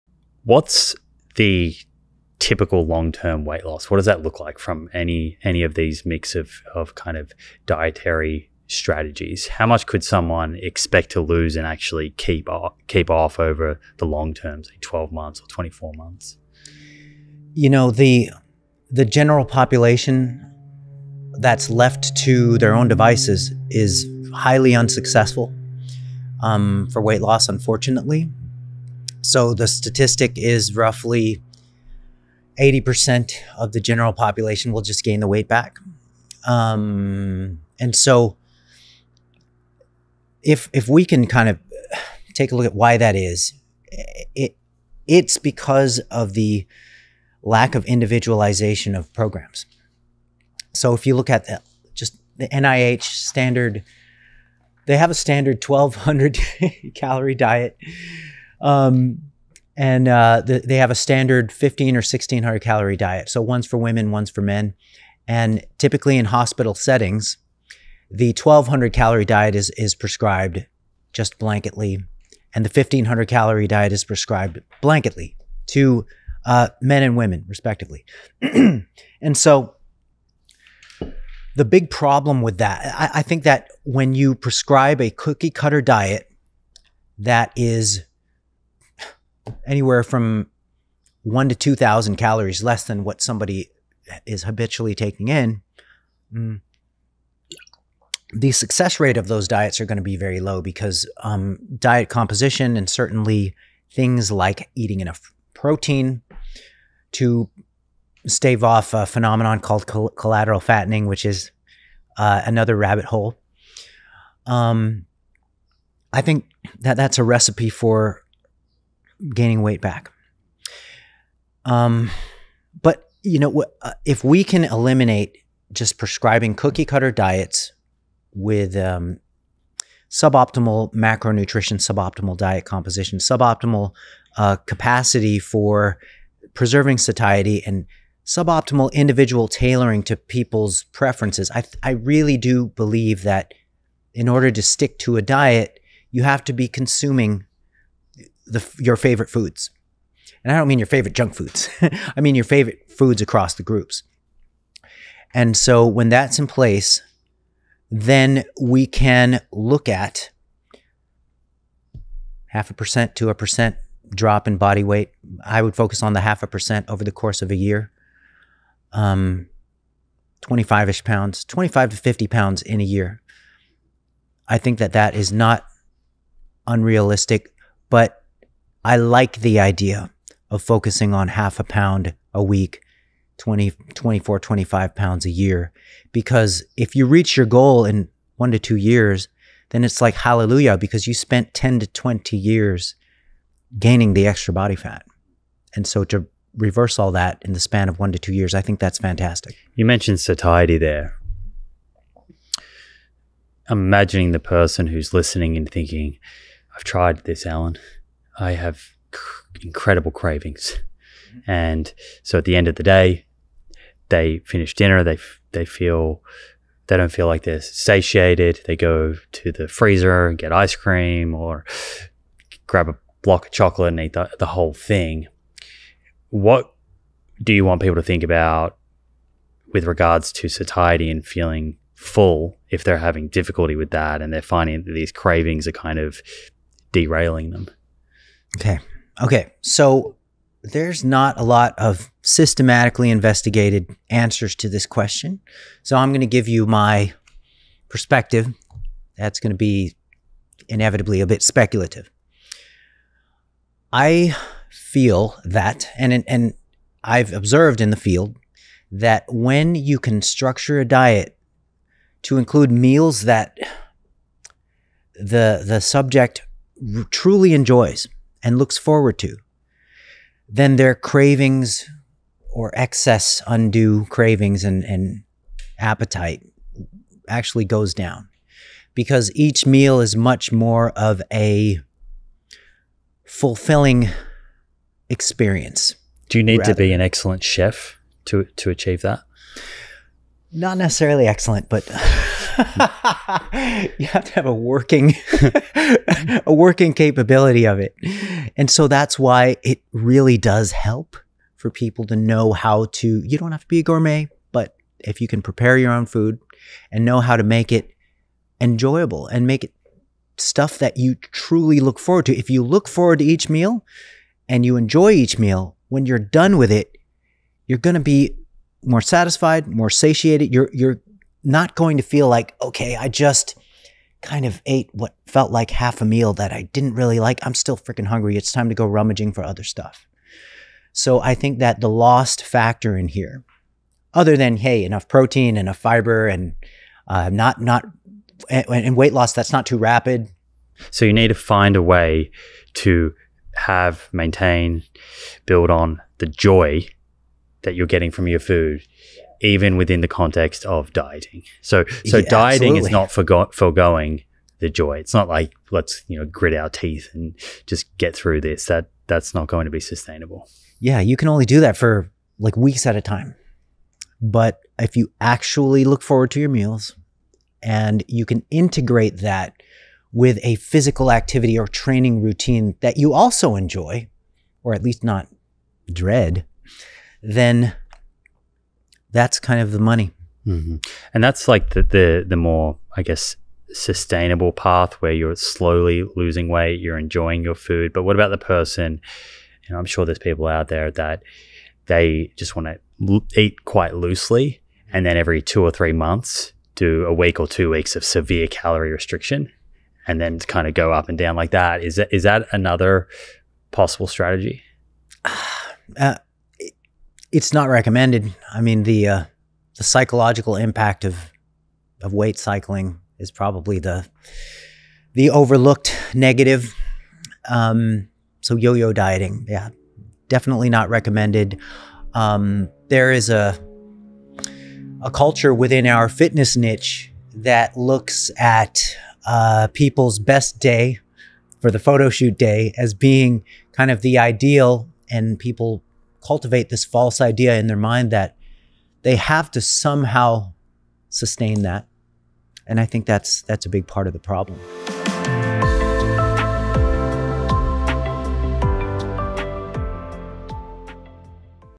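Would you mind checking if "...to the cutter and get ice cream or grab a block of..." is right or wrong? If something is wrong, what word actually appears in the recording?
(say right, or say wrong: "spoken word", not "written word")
wrong: "freezer", not "cutter".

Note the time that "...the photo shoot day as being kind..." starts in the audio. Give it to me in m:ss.
7:11.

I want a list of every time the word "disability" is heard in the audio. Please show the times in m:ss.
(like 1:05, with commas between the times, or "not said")
not said.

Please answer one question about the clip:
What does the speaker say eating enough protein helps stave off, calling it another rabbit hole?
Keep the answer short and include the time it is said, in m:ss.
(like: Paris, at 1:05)
collateral fattening, at 1:49.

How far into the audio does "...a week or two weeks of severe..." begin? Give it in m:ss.
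6:37.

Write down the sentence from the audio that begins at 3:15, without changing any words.
And so to reverse all that in the span of one to two years, I think that's fantastic.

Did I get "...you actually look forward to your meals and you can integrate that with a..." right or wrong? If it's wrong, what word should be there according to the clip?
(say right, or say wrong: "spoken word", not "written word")
right.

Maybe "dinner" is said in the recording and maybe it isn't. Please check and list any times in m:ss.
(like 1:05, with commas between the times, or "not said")
3:34.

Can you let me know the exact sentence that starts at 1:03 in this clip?
So one's for women, one's for men.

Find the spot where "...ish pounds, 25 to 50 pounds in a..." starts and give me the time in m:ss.
2:50.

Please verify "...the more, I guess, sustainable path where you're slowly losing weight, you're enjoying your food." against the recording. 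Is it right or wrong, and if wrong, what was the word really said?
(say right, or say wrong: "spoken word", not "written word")
right.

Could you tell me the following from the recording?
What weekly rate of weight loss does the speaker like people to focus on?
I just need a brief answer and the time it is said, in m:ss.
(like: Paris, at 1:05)
half a pound, at 3:01.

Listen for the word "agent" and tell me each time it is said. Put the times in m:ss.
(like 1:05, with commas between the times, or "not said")
not said.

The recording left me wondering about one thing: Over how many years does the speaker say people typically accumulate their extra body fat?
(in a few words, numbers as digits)
10 to 20 years.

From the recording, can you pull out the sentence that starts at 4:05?
So I'm going to give you my perspective.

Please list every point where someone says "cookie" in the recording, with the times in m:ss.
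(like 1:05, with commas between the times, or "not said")
1:25, 2:06.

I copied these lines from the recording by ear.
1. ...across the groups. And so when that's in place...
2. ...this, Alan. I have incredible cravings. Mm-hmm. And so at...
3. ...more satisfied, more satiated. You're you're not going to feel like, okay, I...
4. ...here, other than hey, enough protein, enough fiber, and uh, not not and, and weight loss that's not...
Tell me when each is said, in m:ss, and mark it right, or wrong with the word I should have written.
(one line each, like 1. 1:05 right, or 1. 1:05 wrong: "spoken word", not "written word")
1. 2:33 right
2. 3:27 right
3. 5:18 right
4. 5:33 right.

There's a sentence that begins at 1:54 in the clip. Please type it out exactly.
Um, I think that that's a recipe for gaining weight back.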